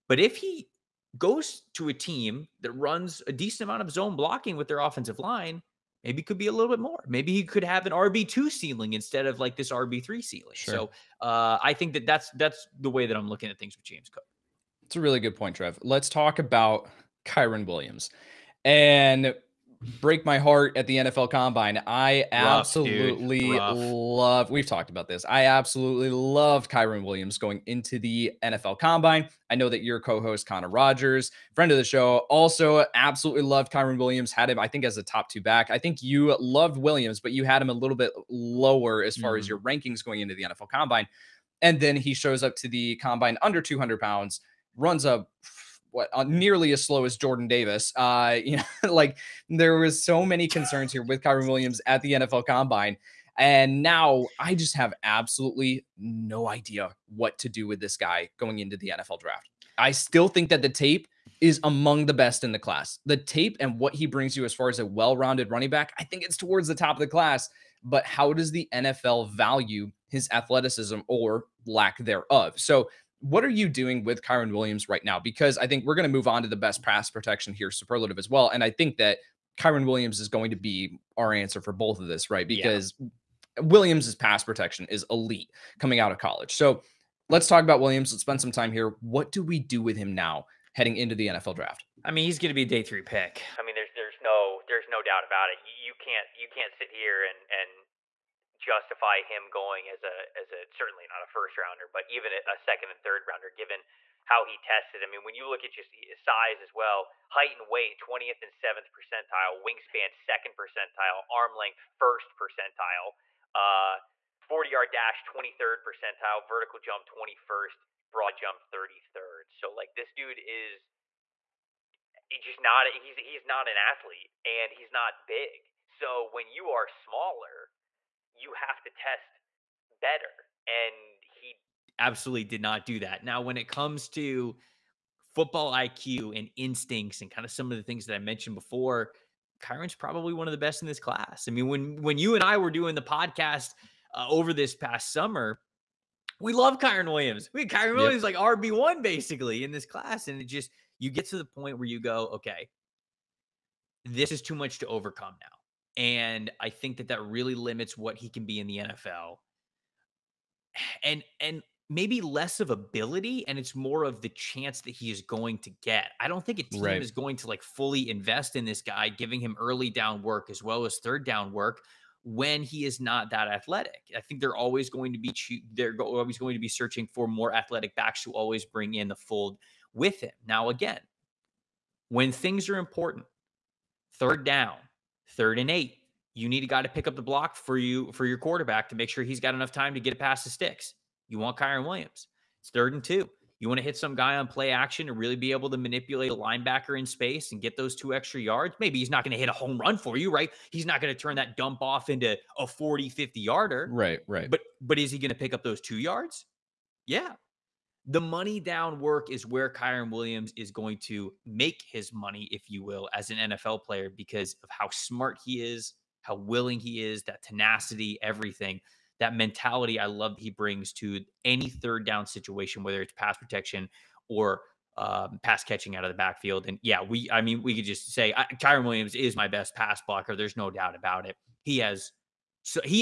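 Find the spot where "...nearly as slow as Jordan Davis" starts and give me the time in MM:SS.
00:46.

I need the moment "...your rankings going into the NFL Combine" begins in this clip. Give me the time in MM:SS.
00:39.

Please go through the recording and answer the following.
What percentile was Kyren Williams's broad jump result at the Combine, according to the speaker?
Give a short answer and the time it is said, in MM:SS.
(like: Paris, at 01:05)
33rd, at 01:58.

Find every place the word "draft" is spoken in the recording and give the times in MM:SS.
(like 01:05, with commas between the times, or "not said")
00:59, 01:31.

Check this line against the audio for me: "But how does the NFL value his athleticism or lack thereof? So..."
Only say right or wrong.
right.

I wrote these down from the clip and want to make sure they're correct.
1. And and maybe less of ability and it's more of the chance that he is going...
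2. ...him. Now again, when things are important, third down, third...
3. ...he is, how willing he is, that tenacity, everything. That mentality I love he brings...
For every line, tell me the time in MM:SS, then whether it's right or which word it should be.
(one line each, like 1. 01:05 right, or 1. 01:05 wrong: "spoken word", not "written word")
1. 02:41 right
2. 03:00 right
3. 03:35 right.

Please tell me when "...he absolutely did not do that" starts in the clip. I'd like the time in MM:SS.
02:11.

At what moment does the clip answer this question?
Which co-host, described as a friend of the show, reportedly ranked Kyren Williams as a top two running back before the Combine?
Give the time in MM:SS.
00:30.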